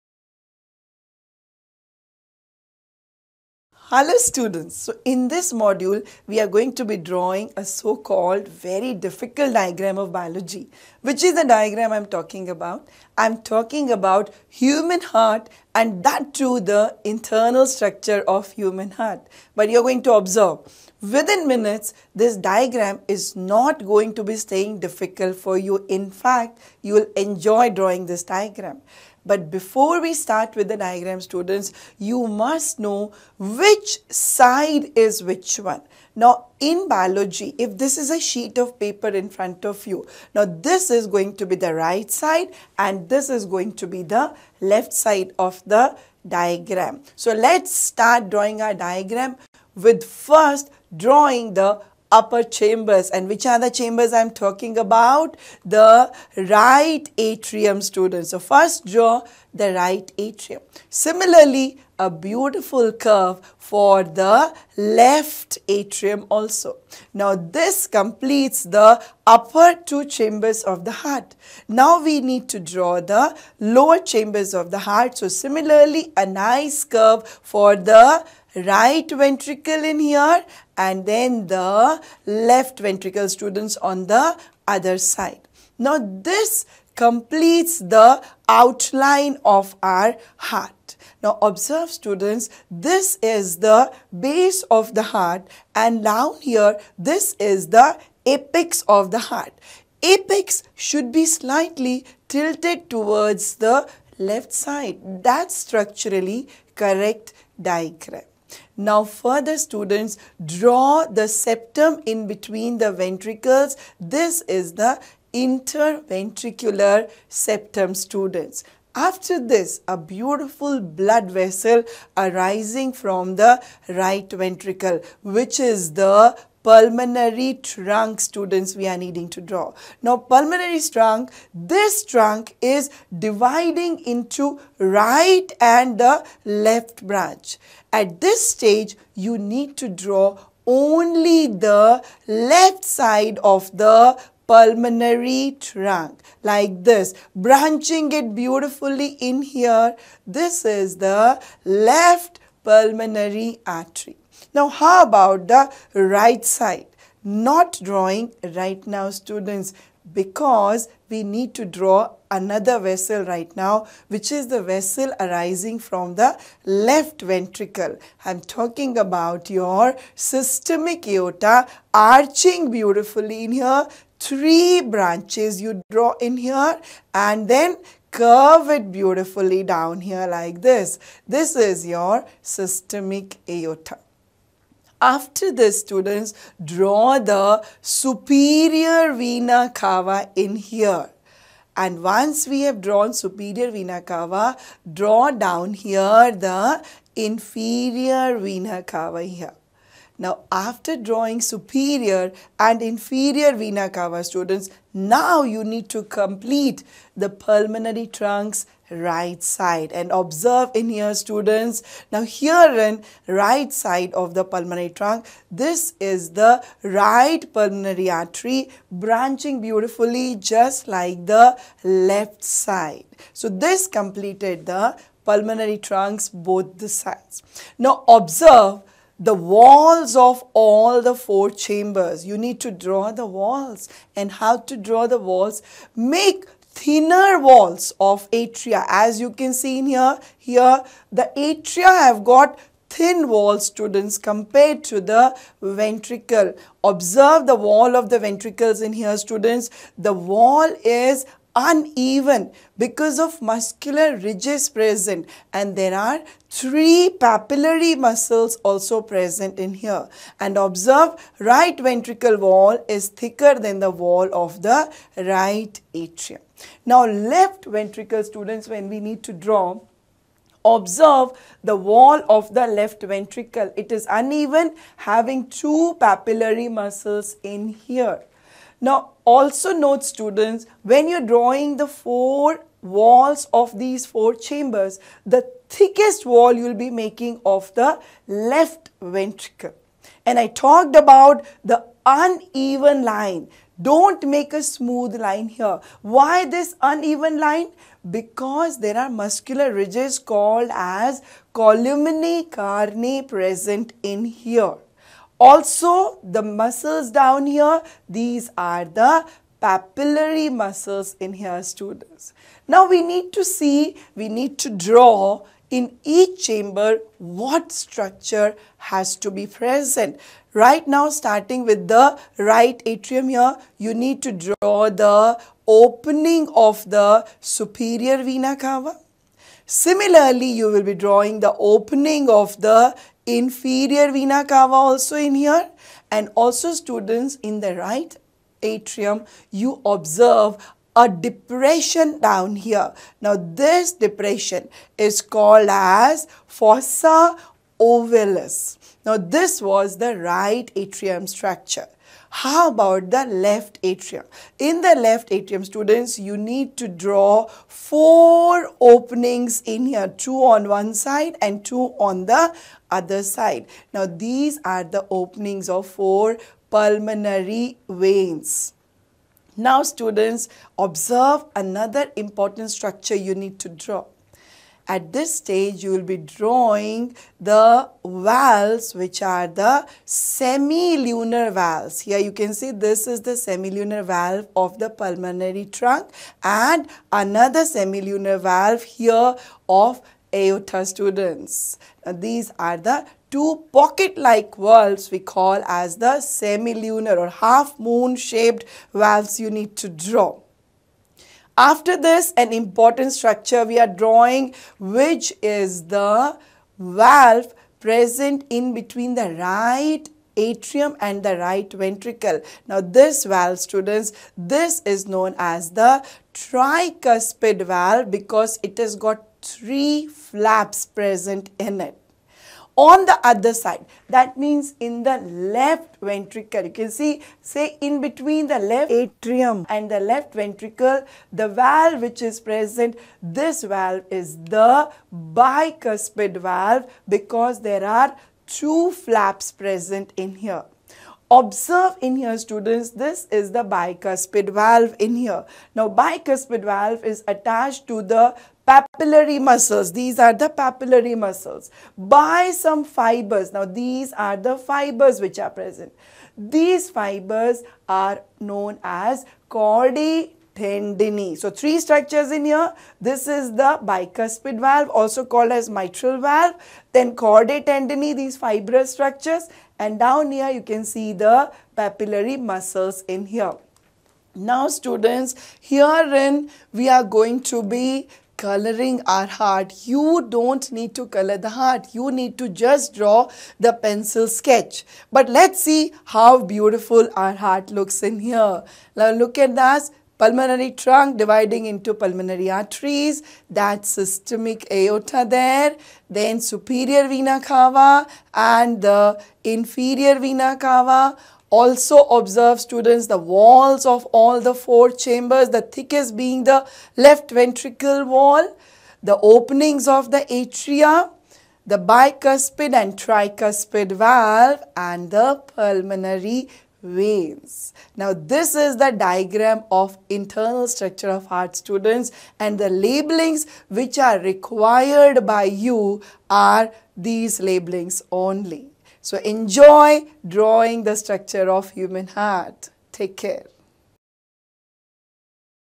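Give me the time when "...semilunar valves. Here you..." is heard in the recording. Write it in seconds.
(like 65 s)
380 s.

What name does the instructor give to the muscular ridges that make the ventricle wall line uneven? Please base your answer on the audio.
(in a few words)
Columnae carneae.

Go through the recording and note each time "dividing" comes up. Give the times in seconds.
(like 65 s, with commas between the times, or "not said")
133 s, 491 s.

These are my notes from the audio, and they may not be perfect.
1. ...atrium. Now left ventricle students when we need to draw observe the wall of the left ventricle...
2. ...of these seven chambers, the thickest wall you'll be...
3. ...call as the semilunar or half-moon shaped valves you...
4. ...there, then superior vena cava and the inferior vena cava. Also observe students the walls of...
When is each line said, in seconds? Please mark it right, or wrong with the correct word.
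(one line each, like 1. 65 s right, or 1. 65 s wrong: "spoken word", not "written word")
1. 265 s right
2. 283 s wrong: "four", not "seven"
3. 395 s right
4. 495 s right.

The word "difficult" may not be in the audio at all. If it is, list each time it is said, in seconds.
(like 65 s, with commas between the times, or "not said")
8 s, 24 s.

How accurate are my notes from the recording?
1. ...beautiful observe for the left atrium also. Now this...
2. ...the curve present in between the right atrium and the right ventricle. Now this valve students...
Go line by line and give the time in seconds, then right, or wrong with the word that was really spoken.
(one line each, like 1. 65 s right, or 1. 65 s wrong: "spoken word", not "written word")
1. 62 s wrong: "curve", not "observe"
2. 405 s wrong: "valve", not "curve".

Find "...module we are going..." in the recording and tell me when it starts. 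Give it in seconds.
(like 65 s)
5 s.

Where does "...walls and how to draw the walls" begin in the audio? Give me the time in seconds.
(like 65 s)
233 s.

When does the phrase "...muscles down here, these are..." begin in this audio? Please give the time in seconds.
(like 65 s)
306 s.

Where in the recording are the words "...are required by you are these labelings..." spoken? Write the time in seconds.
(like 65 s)
523 s.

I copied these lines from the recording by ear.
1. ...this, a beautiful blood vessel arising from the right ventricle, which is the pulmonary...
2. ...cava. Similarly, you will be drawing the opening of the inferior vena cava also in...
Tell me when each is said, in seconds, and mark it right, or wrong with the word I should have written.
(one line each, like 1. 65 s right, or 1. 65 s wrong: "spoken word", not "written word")
1. 119 s right
2. 328 s right.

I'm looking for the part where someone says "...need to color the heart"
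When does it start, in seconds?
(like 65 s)
480 s.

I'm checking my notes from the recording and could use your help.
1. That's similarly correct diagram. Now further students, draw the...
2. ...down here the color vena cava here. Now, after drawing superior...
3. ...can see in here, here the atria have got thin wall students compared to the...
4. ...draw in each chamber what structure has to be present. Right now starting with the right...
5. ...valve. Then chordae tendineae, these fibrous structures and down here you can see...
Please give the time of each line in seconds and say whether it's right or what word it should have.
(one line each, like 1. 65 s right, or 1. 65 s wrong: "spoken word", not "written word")
1. 105 s wrong: "structurally", not "similarly"
2. 195 s wrong: "inferior", not "color"
3. 239 s right
4. 314 s right
5. 466 s right.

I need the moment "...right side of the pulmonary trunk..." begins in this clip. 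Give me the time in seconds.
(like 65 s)
213 s.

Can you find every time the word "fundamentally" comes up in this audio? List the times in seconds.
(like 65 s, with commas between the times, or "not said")
not said.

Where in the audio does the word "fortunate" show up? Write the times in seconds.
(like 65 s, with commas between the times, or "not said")
not said.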